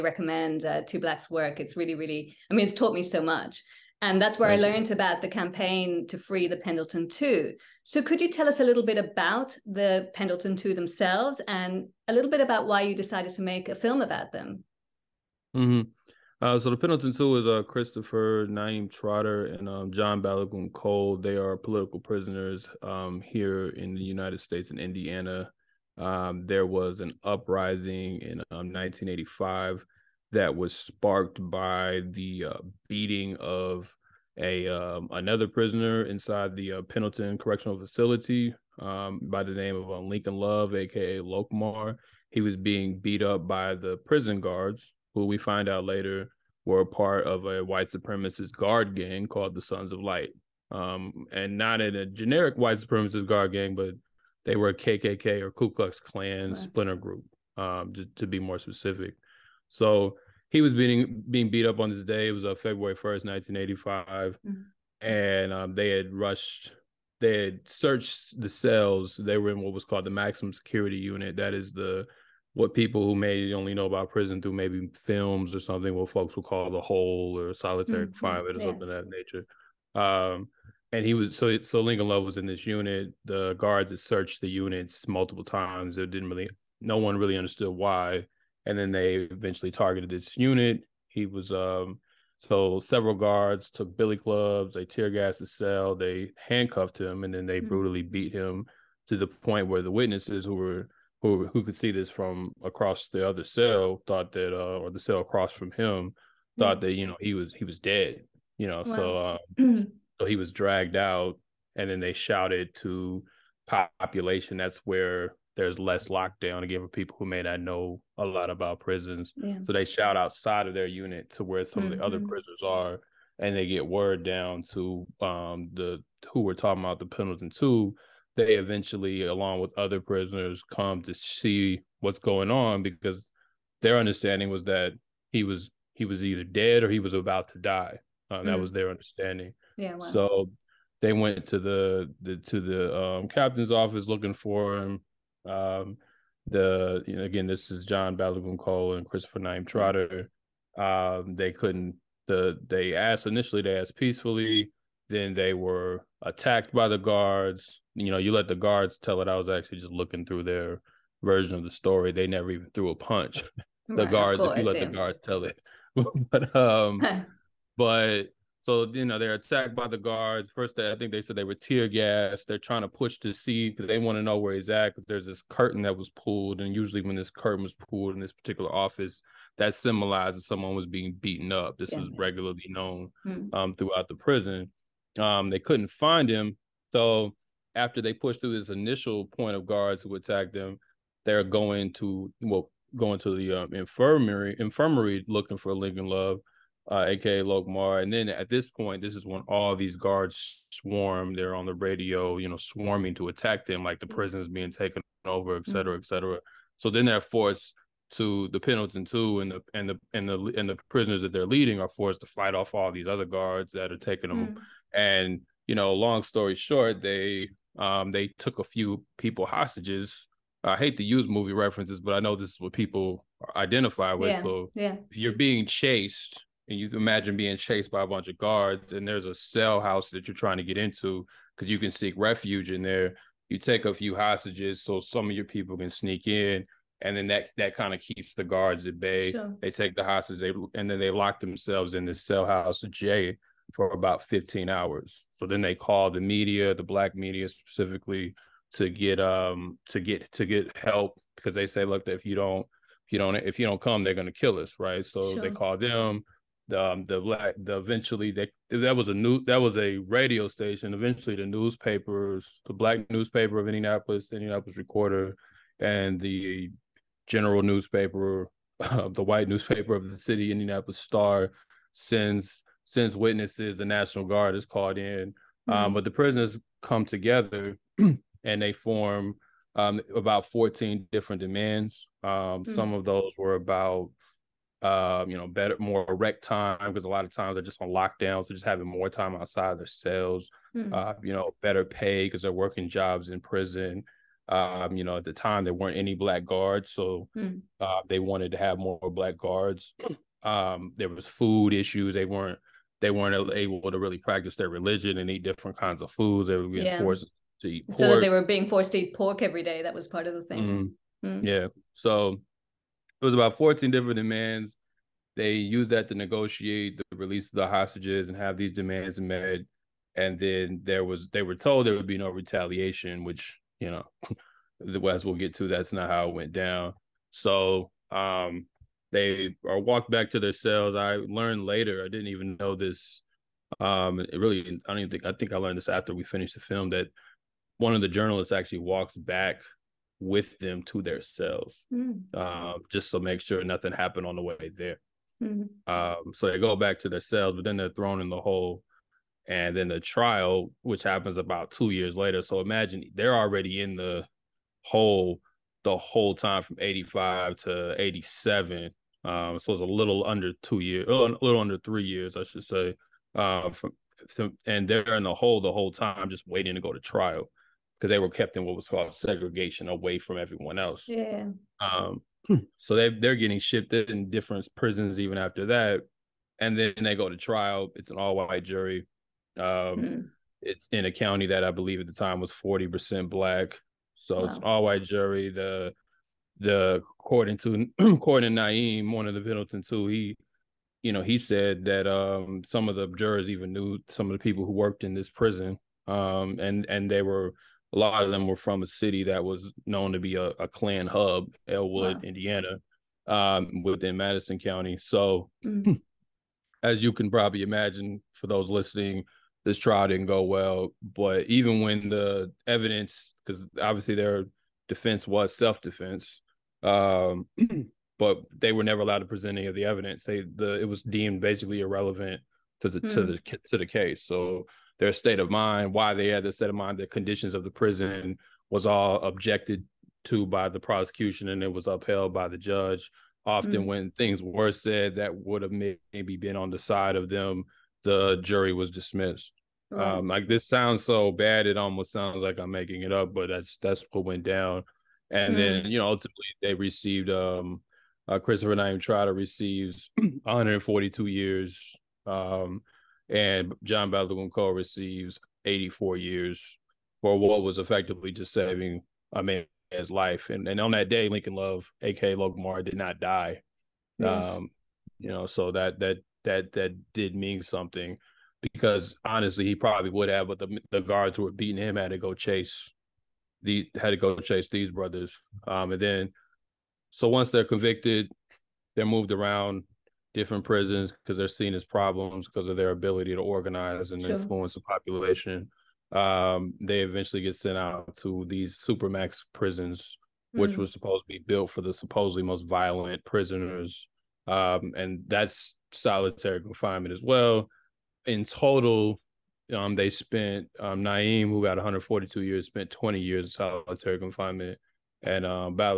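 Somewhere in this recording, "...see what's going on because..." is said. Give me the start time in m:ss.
2:11.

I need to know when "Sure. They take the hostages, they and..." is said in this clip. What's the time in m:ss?
3:59.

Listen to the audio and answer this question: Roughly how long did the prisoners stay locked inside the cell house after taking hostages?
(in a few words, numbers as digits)
15 hours.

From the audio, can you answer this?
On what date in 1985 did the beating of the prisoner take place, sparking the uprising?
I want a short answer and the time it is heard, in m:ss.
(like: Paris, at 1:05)
February 1st, at 1:02.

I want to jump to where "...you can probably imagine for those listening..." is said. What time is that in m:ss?
6:47.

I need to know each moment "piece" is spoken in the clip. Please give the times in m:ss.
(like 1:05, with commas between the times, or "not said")
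not said.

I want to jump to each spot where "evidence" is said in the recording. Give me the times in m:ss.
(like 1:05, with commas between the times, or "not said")
6:52, 6:59.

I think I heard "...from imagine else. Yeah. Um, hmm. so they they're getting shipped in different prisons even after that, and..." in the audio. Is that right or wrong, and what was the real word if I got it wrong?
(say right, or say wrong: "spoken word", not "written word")
wrong: "everyone", not "imagine".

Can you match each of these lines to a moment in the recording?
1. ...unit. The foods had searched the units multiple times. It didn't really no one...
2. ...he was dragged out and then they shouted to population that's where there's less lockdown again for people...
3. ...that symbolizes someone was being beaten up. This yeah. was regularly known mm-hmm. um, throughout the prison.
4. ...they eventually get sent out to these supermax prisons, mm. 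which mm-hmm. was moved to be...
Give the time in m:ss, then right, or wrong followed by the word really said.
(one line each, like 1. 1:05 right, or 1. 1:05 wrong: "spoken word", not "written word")
1. 1:22 wrong: "guards", not "foods"
2. 1:50 right
3. 2:59 right
4. 8:06 wrong: "supposed", not "moved".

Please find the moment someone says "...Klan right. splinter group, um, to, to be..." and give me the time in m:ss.
0:55.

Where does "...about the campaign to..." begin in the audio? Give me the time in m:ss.
0:04.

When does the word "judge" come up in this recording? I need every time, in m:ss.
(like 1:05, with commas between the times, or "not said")
7:12.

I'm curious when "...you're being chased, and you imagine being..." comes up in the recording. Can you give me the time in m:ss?
3:45.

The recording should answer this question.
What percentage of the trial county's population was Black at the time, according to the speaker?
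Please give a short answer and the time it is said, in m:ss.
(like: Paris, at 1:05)
40%, at 6:22.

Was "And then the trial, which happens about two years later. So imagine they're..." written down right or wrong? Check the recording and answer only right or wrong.
right.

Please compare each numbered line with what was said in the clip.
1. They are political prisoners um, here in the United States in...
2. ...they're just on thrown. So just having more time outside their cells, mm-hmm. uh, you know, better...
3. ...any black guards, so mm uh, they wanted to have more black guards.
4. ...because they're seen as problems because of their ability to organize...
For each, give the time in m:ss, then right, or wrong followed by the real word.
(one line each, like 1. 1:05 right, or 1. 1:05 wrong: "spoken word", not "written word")
1. 0:21 right
2. 4:47 wrong: "lockdown", not "thrown"
3. 4:55 right
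4. 8:01 right.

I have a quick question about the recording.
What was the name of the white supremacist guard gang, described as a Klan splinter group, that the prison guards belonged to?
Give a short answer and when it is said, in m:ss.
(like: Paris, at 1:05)
Sons of Light, at 0:49.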